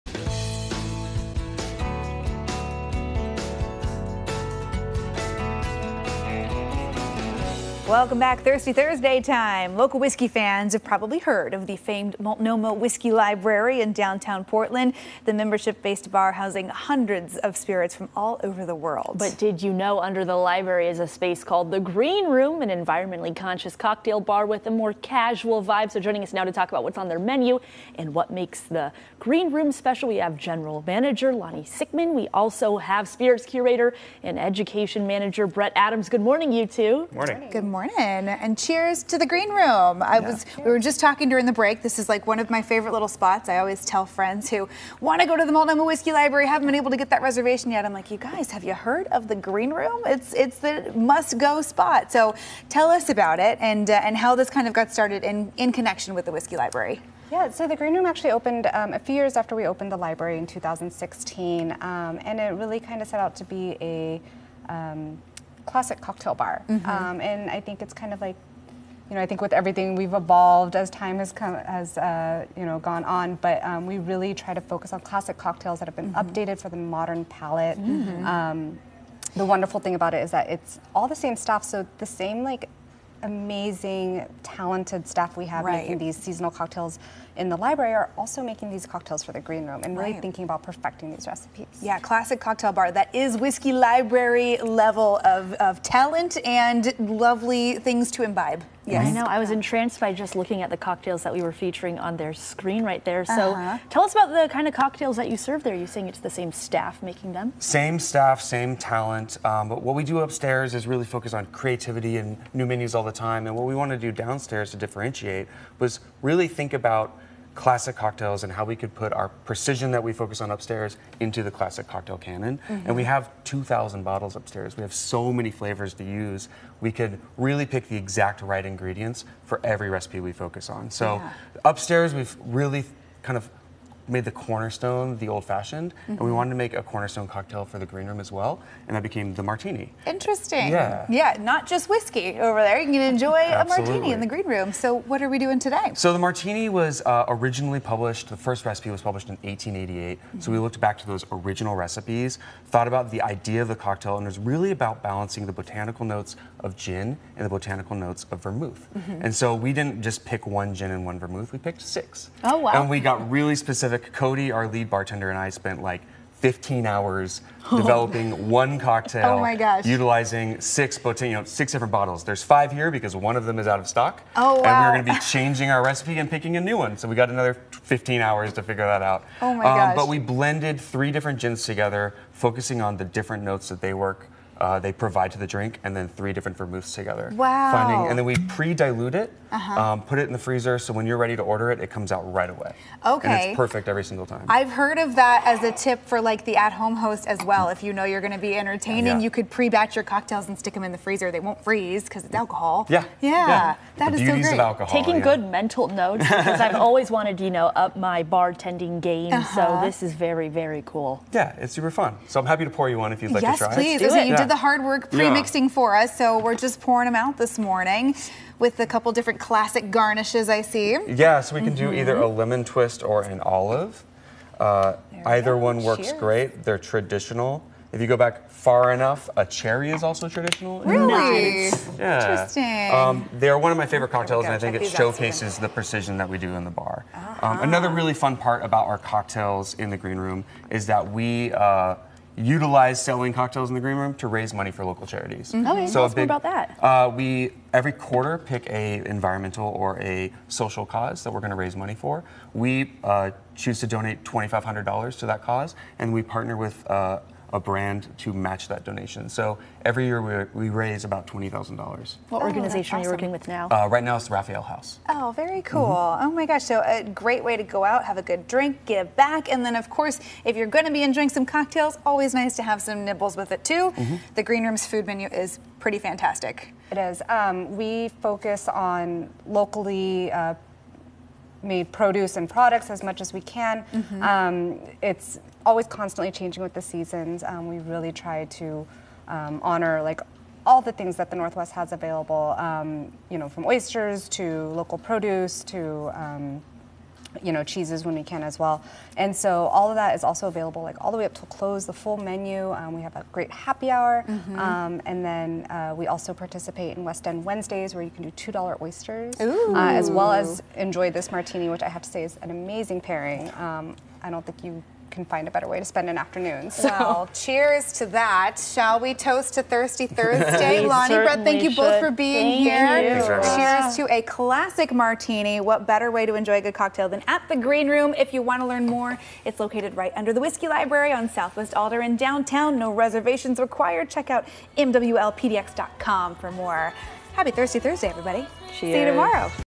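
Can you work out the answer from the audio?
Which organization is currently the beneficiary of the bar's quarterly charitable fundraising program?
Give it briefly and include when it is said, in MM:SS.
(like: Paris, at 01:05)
Raphael House, at 04:24.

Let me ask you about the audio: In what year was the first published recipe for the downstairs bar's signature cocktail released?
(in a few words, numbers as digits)
1888.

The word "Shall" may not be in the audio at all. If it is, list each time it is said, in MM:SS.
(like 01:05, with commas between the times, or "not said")
05:18.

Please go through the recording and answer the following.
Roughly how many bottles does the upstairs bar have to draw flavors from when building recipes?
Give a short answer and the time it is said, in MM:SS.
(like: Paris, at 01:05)
2,000, at 02:03.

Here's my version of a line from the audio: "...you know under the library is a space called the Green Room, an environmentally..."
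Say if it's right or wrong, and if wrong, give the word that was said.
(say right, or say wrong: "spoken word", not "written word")
right.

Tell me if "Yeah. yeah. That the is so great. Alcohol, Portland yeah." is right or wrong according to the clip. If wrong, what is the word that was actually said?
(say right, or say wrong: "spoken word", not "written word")
wrong: "Taking", not "Portland".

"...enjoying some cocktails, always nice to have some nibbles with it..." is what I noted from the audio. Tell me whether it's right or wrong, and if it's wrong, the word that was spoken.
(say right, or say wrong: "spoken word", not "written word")
right.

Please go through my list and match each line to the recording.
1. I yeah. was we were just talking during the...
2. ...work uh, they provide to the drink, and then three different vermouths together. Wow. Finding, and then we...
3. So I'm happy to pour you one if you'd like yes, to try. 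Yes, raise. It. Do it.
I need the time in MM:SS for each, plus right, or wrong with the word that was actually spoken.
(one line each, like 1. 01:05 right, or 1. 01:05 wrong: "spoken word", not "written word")
1. 00:40 right
2. 03:03 right
3. 03:32 wrong: "please", not "raise".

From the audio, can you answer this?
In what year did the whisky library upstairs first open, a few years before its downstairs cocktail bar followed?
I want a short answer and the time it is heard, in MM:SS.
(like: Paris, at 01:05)
2016, at 01:00.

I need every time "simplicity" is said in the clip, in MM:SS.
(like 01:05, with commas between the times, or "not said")
not said.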